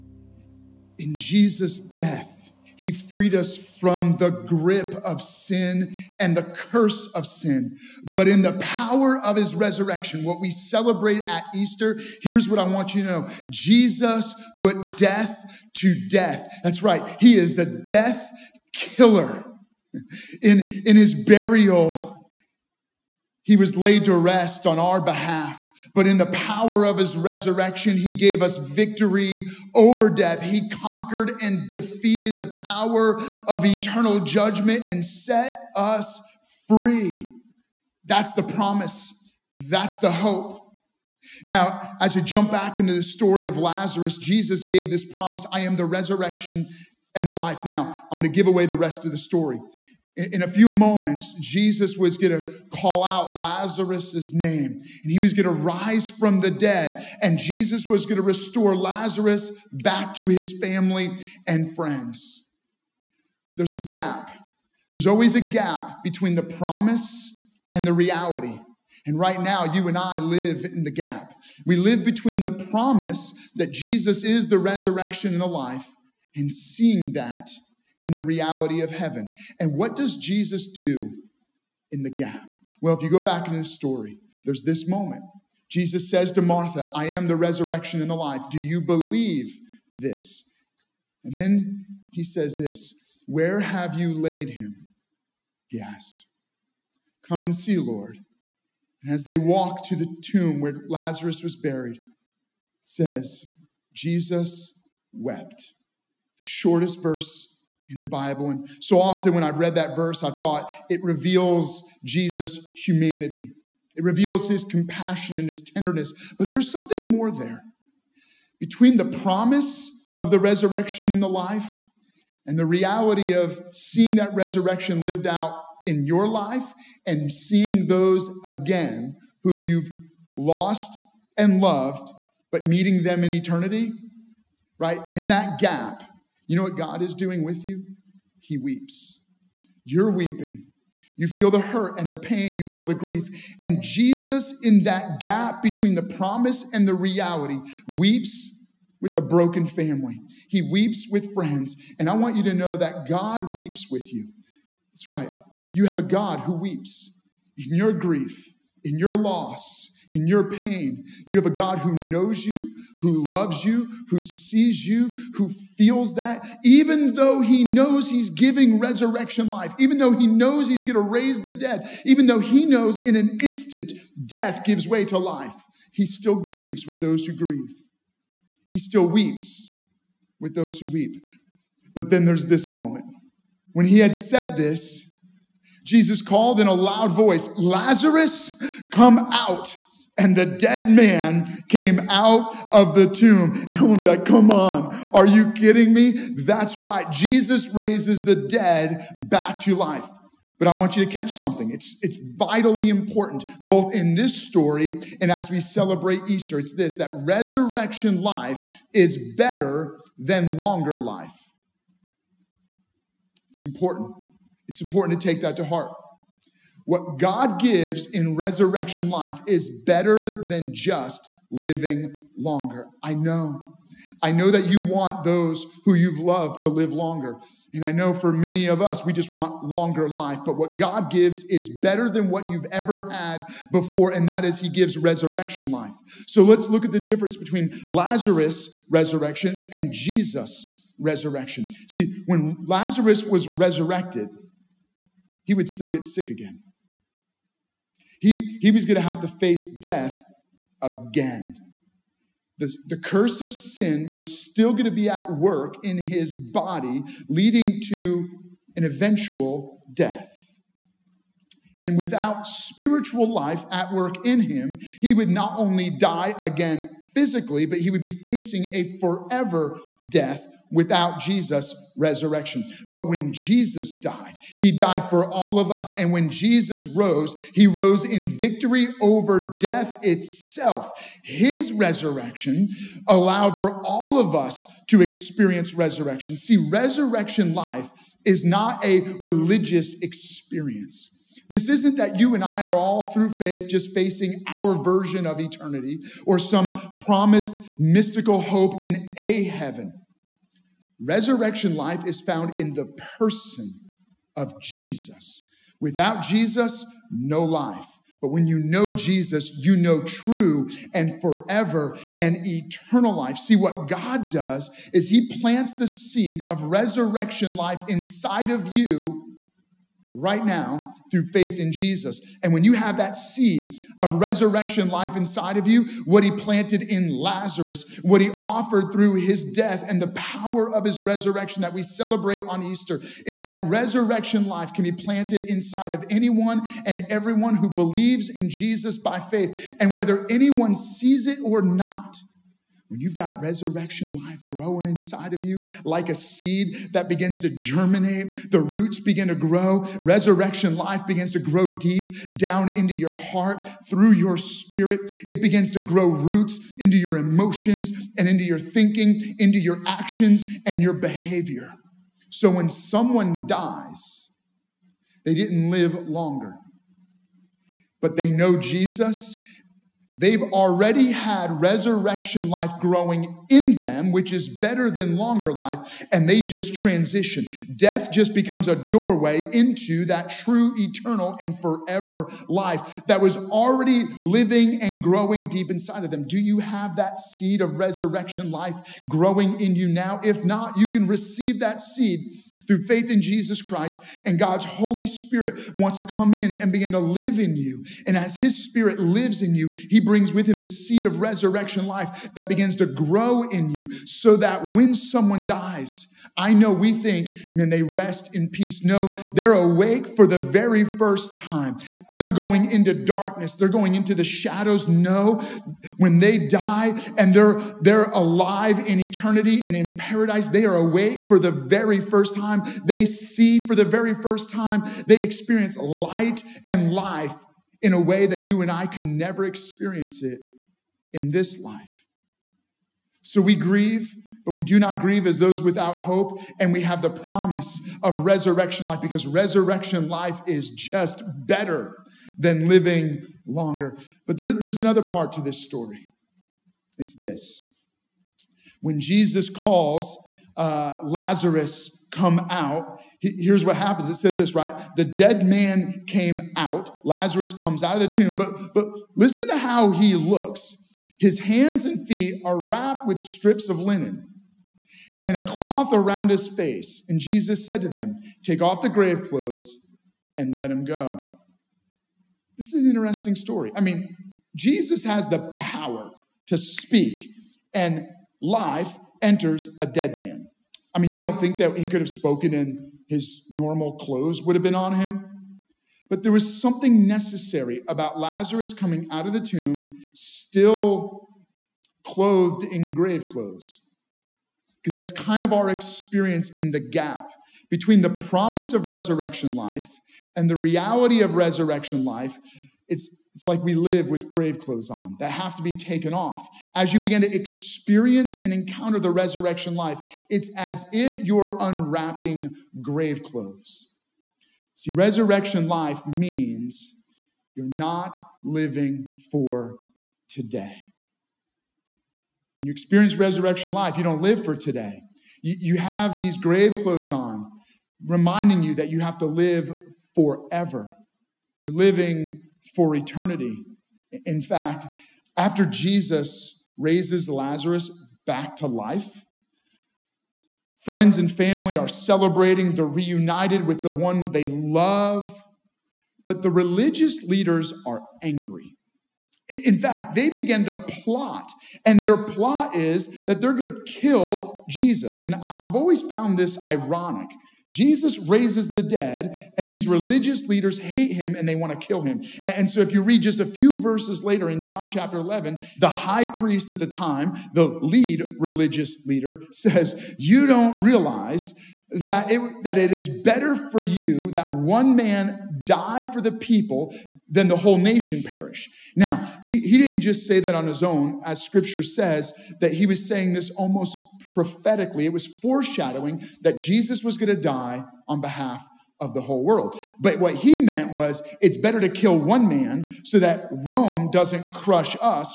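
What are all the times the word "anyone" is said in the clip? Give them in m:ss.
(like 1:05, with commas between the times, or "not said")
5:36, 5:40.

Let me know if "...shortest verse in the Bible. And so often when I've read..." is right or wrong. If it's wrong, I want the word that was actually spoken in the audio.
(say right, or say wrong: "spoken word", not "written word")
right.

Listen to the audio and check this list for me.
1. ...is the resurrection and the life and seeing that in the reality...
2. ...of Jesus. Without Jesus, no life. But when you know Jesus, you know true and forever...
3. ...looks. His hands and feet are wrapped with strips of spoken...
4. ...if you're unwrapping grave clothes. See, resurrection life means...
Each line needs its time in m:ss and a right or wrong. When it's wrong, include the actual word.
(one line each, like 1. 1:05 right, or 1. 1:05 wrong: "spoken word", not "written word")
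1. 1:14 right
2. 5:04 right
3. 7:40 wrong: "linen", not "spoken"
4. 8:30 right.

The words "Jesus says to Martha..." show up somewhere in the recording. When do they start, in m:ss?
1:25.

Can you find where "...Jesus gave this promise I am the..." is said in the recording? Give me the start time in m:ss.
0:44.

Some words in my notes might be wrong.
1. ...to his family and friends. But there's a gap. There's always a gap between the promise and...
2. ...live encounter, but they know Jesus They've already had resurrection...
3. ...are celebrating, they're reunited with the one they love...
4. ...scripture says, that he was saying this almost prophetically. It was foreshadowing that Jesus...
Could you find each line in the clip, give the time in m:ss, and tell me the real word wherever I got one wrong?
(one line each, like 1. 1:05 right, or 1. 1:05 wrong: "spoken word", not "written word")
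1. 1:00 right
2. 6:05 wrong: "longer", not "encounter"
3. 9:01 right
4. 9:41 right.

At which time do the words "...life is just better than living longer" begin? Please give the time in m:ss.
7:20.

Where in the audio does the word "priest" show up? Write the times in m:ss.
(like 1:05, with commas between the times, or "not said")
9:26.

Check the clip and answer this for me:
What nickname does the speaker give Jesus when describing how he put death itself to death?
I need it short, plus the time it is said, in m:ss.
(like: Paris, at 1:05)
death killer, at 0:17.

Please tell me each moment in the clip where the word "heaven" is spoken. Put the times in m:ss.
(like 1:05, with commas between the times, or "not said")
1:18, 4:59.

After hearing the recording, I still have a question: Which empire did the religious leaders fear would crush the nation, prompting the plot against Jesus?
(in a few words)
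Rome.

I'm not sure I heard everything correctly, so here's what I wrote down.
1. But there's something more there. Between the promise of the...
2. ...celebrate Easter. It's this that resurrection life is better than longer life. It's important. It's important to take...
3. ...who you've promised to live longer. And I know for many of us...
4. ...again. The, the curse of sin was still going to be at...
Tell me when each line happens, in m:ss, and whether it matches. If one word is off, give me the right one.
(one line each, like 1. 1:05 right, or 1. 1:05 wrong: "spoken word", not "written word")
1. 1:56 right
2. 3:25 right
3. 3:45 wrong: "loved", not "promised"
4. 4:10 right.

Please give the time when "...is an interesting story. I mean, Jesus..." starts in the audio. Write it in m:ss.
7:52.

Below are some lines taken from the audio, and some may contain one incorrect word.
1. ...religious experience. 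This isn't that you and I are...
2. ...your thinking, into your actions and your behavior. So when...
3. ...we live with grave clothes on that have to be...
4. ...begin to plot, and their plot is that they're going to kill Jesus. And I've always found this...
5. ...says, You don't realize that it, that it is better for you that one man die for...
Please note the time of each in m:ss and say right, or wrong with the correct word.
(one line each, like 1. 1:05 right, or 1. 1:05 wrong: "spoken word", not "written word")
1. 4:49 right
2. 5:58 right
3. 8:23 right
4. 9:10 right
5. 9:29 right.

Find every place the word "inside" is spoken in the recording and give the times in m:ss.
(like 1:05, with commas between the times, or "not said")
5:17, 5:25, 5:35, 5:44, 6:25.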